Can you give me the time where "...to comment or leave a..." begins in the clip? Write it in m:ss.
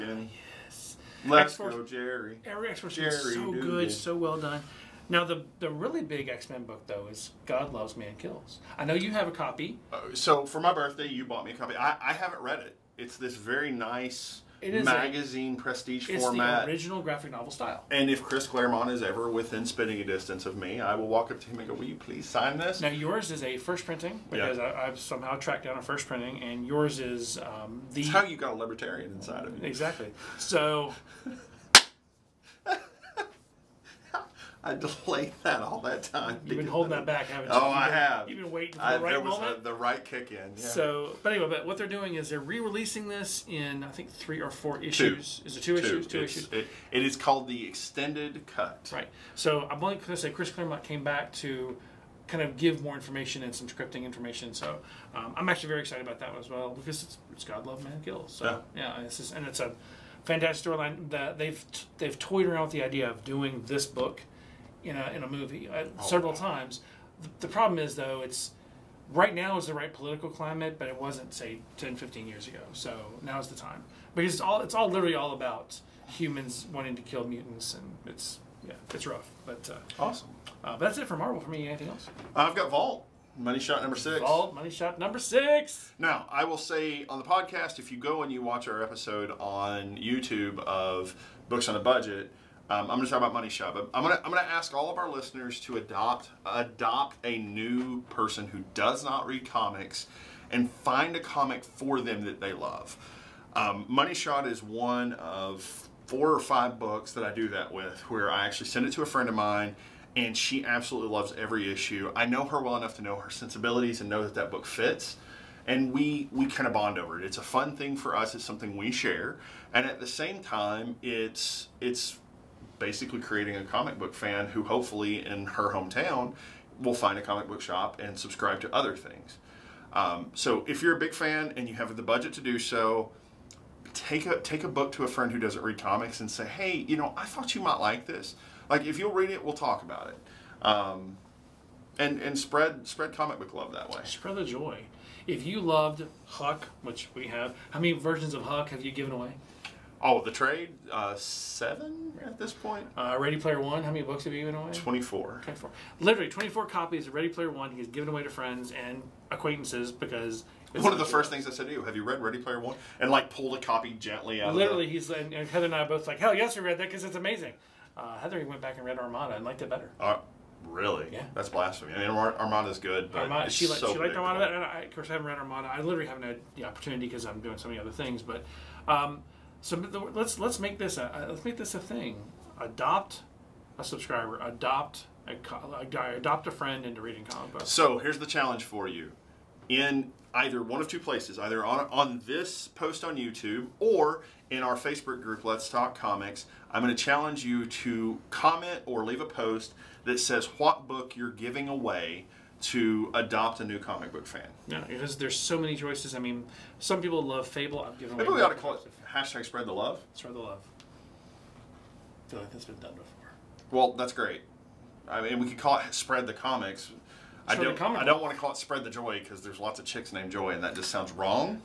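3:17.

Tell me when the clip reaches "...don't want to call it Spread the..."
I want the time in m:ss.
3:38.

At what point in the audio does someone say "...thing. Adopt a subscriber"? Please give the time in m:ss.
3:01.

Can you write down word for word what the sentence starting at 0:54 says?
So um, I'm actually very excited about that as well because it's, it's God Love Man Kills.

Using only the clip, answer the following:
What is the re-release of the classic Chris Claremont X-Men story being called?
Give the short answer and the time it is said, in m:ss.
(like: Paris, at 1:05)
the extended cut, at 0:47.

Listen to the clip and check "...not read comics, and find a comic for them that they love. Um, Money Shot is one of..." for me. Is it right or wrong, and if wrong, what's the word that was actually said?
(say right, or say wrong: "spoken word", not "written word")
right.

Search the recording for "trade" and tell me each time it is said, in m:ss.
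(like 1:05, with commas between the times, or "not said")
2:30.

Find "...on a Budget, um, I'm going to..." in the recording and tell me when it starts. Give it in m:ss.
1:31.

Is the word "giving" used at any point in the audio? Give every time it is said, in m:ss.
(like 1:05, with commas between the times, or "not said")
3:21.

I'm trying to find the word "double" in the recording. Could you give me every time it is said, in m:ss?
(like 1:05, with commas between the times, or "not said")
not said.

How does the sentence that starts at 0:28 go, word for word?
It's how you got a libertarian inside of you.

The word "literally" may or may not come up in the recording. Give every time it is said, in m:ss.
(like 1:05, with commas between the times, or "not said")
1:14, 2:35, 2:44, 2:55.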